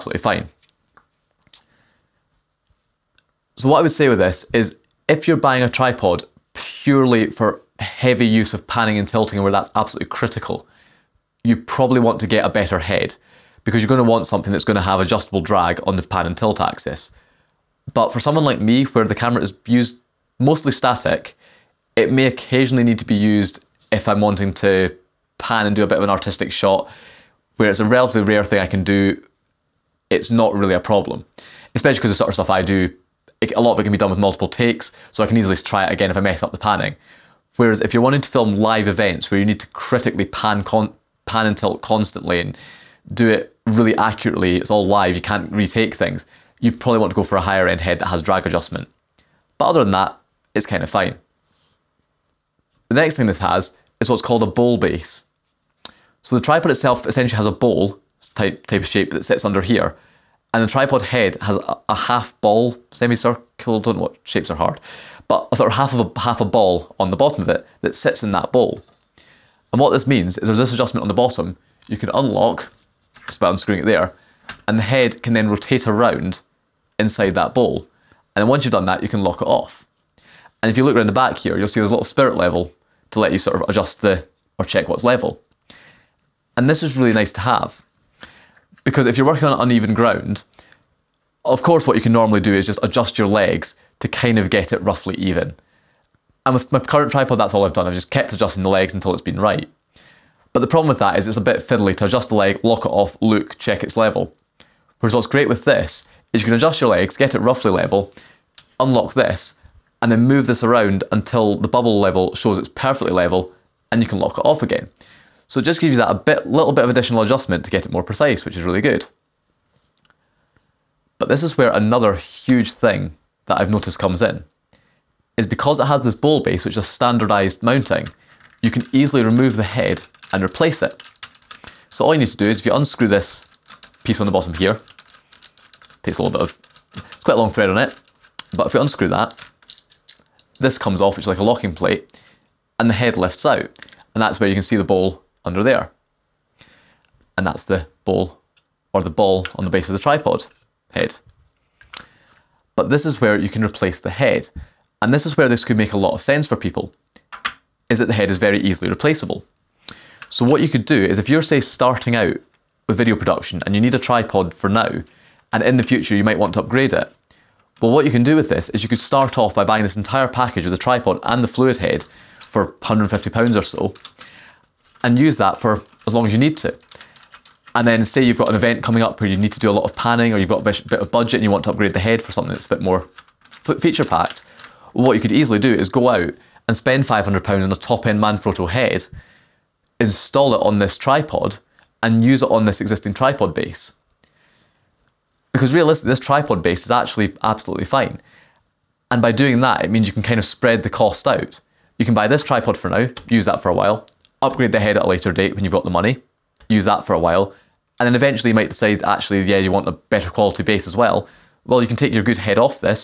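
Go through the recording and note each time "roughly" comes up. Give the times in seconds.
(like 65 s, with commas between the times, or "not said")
94 s, 107 s.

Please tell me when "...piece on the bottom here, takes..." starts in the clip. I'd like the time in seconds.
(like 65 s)
134 s.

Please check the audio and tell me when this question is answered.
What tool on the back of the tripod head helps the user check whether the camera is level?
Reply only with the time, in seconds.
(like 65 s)
82 s.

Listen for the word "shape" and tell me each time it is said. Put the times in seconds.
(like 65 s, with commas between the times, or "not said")
58 s, 64 s.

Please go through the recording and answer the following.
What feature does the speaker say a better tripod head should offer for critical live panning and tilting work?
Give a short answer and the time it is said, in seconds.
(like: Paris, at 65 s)
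Drag adjustment, at 48 s.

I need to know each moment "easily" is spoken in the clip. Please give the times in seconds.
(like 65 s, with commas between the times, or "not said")
35 s, 128 s, 158 s, 185 s.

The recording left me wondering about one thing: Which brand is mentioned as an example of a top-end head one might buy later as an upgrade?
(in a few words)
Manfrotto.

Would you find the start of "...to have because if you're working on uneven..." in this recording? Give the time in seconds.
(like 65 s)
87 s.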